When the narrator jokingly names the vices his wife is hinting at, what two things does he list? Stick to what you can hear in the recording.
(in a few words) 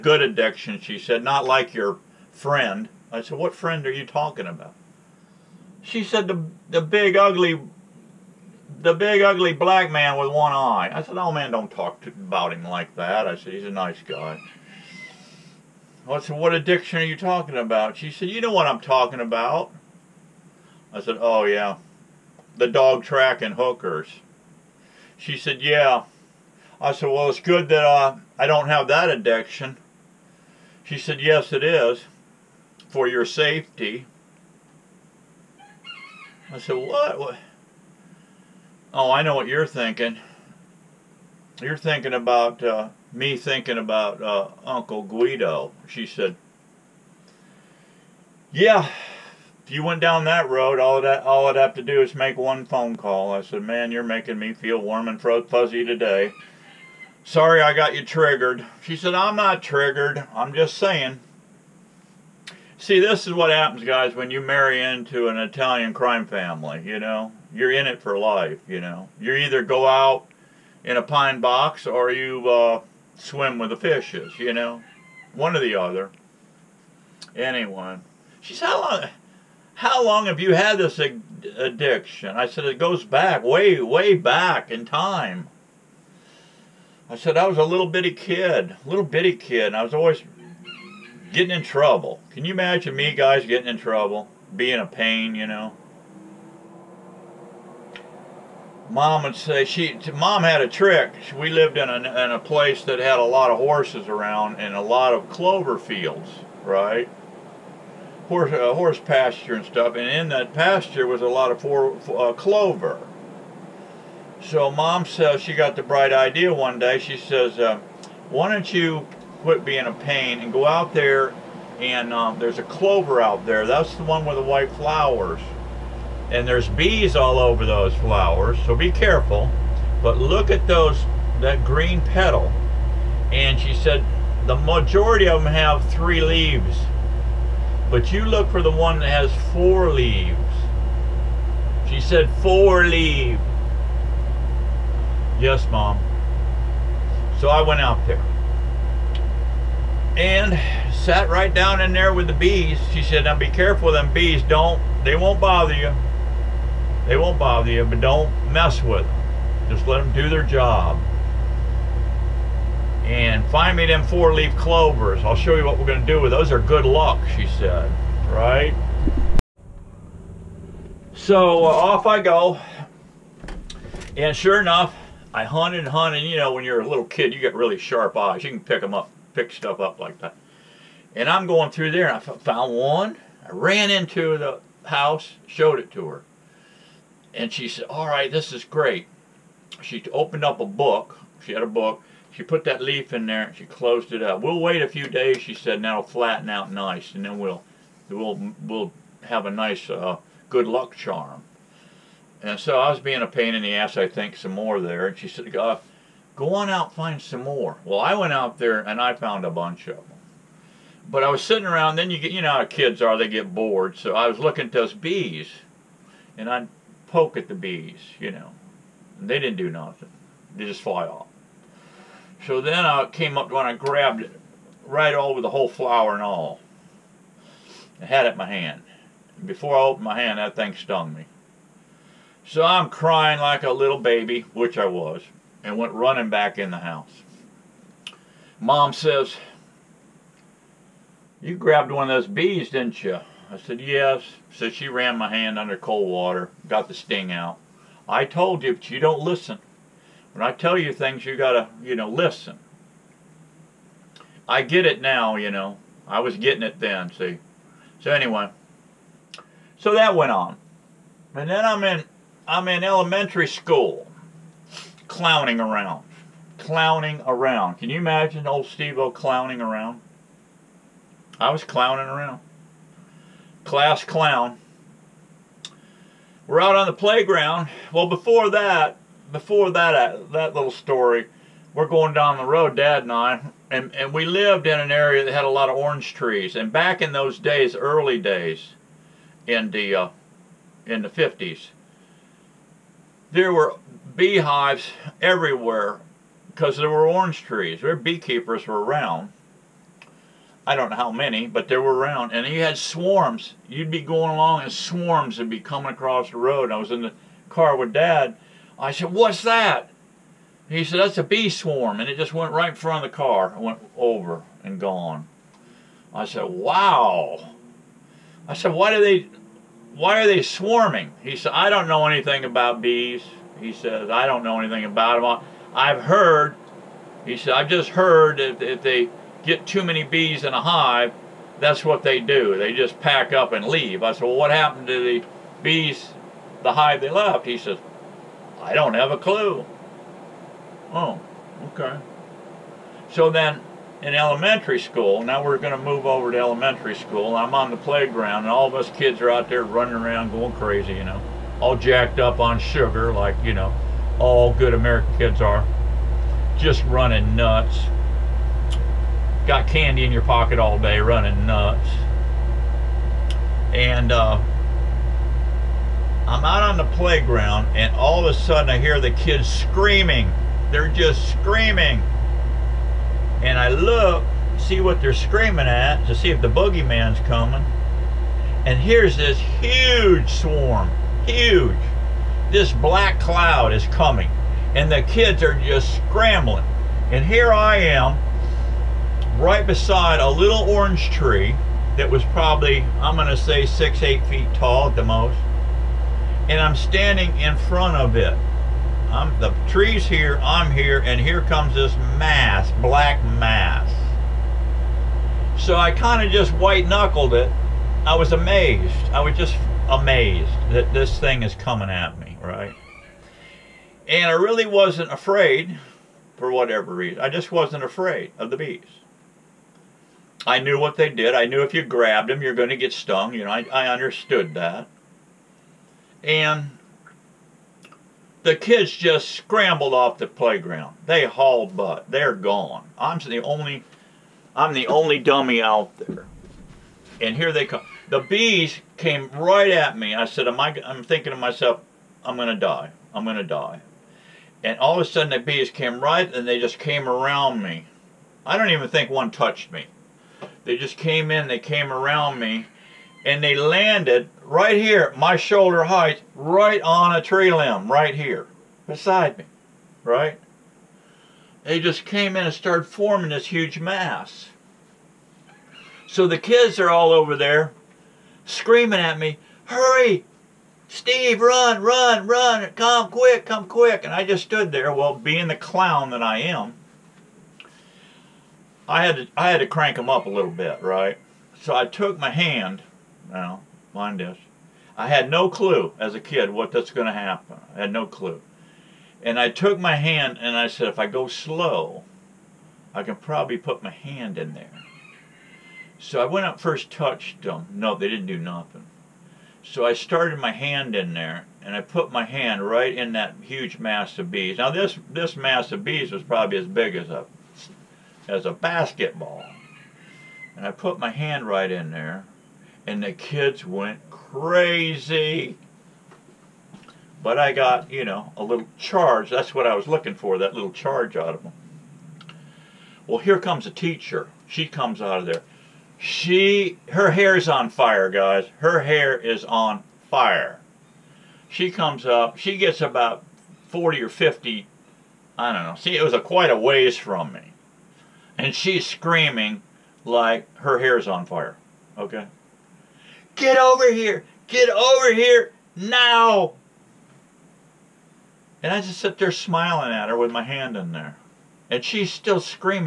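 Dog track and hookers.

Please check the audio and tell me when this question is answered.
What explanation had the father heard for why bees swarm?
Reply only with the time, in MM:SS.
05:29.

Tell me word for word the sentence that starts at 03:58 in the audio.
Mom says, You grabbed one of those bees, didn't you?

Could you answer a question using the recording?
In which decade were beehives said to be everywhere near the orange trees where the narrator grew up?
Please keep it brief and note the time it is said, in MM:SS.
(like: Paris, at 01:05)
The 50s, at 04:51.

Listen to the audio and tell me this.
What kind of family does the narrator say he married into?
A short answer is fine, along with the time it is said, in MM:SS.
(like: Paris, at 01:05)
Italian crime family, at 01:05.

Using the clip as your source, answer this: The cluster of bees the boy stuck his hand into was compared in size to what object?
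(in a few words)
A basketball.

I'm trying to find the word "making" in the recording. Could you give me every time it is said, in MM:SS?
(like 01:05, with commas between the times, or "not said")
00:54.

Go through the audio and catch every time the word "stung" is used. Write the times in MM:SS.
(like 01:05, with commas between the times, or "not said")
03:50, 07:02.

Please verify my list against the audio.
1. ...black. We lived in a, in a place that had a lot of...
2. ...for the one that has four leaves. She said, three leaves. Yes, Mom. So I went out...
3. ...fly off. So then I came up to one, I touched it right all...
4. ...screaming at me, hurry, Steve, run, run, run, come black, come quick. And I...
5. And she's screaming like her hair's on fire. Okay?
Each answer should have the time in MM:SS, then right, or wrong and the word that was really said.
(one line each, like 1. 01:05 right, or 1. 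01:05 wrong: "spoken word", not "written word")
1. 01:40 wrong: "trick", not "black"
2. 02:18 wrong: "four", not "three"
3. 03:40 wrong: "grabbed", not "touched"
4. 07:48 wrong: "quick", not "black"
5. 08:58 right.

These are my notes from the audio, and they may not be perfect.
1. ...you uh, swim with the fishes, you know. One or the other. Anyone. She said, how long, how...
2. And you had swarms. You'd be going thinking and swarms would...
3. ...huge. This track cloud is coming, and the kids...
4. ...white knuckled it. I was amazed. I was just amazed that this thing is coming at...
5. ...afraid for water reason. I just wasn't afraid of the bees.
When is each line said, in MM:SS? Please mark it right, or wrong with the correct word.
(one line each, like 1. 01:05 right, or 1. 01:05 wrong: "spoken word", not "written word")
1. 01:12 right
2. 05:02 wrong: "along", not "thinking"
3. 06:21 wrong: "black", not "track"
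4. 06:46 right
5. 06:55 wrong: "whatever", not "water".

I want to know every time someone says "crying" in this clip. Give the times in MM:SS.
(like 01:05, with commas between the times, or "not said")
03:52.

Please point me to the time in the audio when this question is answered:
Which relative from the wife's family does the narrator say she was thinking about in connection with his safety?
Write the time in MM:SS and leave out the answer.
00:44.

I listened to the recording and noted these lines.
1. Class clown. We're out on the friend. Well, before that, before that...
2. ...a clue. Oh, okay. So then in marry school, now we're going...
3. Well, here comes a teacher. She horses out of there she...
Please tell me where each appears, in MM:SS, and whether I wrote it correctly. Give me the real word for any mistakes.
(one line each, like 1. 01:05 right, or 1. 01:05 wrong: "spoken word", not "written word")
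1. 04:33 wrong: "playground", not "friend"
2. 05:39 wrong: "elementary", not "marry"
3. 08:43 wrong: "comes", not "horses".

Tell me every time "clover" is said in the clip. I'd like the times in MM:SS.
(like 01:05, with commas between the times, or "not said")
01:45, 01:52, 02:02, 02:44.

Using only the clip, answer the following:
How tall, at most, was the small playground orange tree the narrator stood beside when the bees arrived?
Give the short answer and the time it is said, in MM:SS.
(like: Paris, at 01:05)
8 feet, at 06:34.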